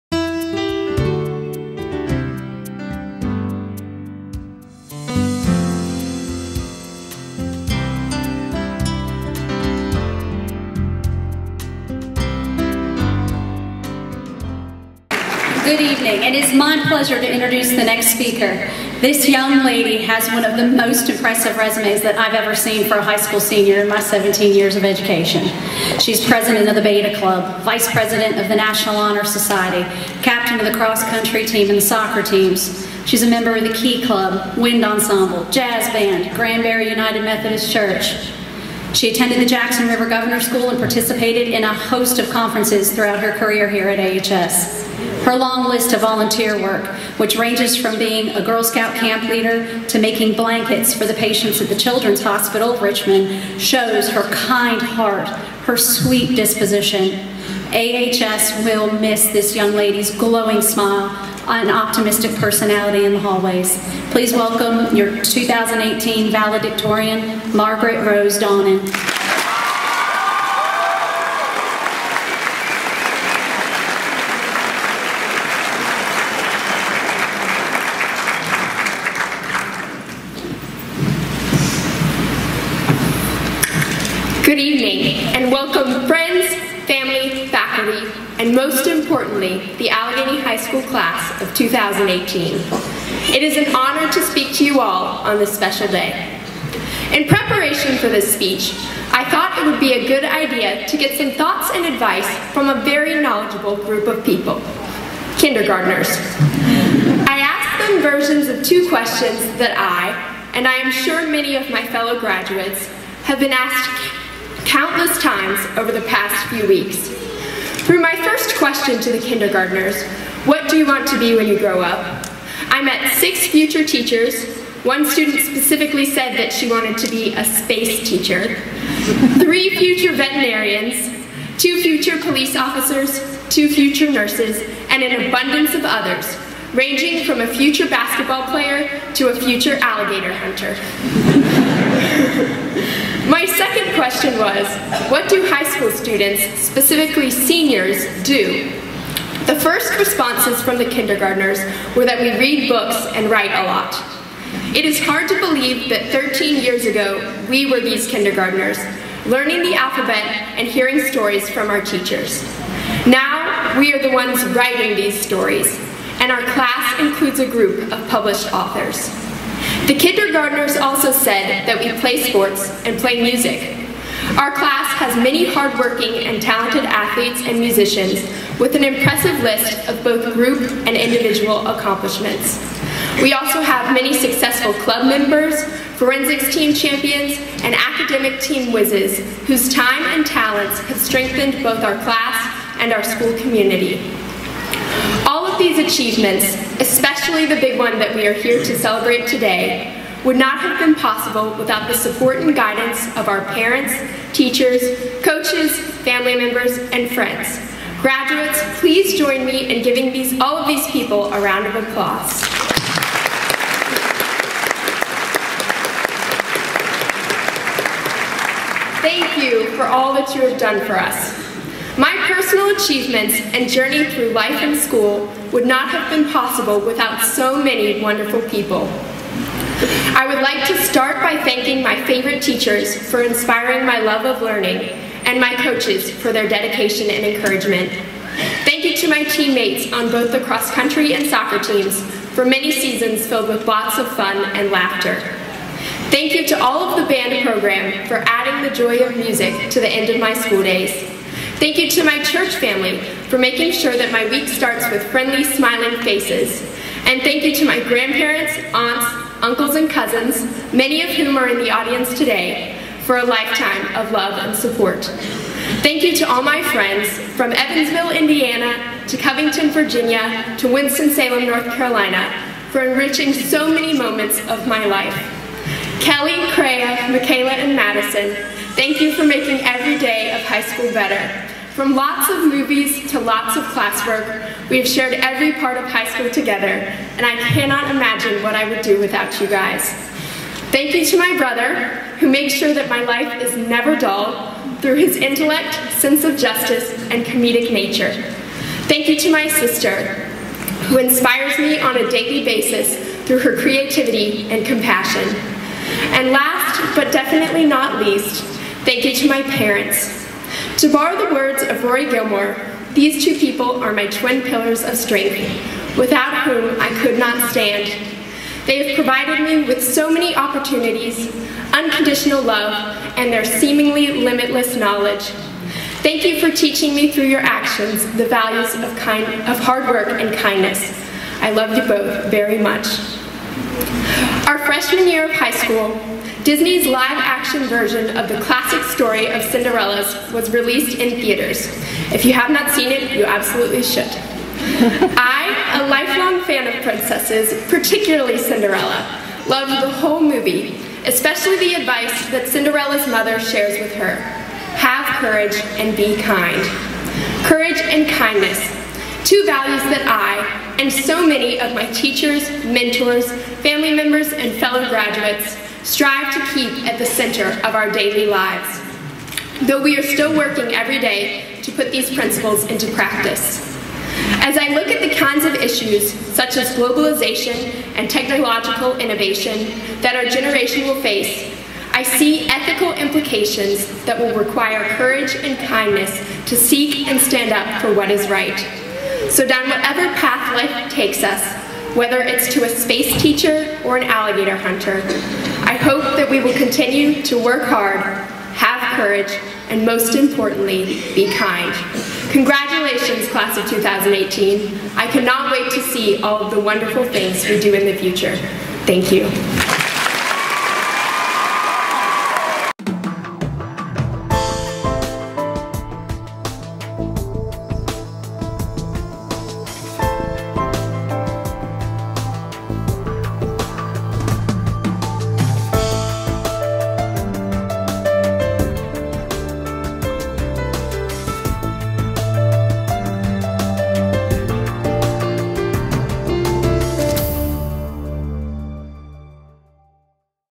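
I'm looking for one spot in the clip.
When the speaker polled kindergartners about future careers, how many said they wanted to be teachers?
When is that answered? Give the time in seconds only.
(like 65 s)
123 s.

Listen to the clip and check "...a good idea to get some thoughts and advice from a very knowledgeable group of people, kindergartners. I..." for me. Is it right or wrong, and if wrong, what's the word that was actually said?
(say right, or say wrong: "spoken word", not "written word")
right.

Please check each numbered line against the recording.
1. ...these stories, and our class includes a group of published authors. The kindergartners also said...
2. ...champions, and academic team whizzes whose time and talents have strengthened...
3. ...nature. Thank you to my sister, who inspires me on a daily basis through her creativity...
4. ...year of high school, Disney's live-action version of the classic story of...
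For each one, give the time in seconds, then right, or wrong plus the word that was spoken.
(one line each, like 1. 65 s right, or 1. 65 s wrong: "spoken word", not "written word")
1. 164 s right
2. 186 s right
3. 297 s right
4. 335 s right.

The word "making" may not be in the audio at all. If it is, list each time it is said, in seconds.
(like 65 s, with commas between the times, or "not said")
49 s, 253 s, 279 s.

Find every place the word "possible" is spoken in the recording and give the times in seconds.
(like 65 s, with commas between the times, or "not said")
200 s, 226 s.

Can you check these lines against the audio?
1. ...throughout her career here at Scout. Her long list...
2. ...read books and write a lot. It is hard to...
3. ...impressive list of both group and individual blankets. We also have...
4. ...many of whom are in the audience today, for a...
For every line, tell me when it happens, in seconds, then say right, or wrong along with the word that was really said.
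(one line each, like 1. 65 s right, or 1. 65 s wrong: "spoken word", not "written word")
1. 42 s wrong: "AHS", not "Scout"
2. 152 s right
3. 178 s wrong: "accomplishments", not "blankets"
4. 260 s right.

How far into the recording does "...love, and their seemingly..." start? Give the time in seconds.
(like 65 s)
322 s.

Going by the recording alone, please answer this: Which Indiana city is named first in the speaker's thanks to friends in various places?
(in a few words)
Evansville.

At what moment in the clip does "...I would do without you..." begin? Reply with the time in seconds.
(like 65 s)
288 s.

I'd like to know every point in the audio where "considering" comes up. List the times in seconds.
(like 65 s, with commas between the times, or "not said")
not said.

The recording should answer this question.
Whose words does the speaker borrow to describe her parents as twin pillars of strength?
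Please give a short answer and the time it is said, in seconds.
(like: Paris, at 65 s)
Roy Gilmore, at 311 s.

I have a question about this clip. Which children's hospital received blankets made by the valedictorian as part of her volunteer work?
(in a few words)
Children's Hospital of Richmond.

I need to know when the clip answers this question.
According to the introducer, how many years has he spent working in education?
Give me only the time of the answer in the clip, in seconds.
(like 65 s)
23 s.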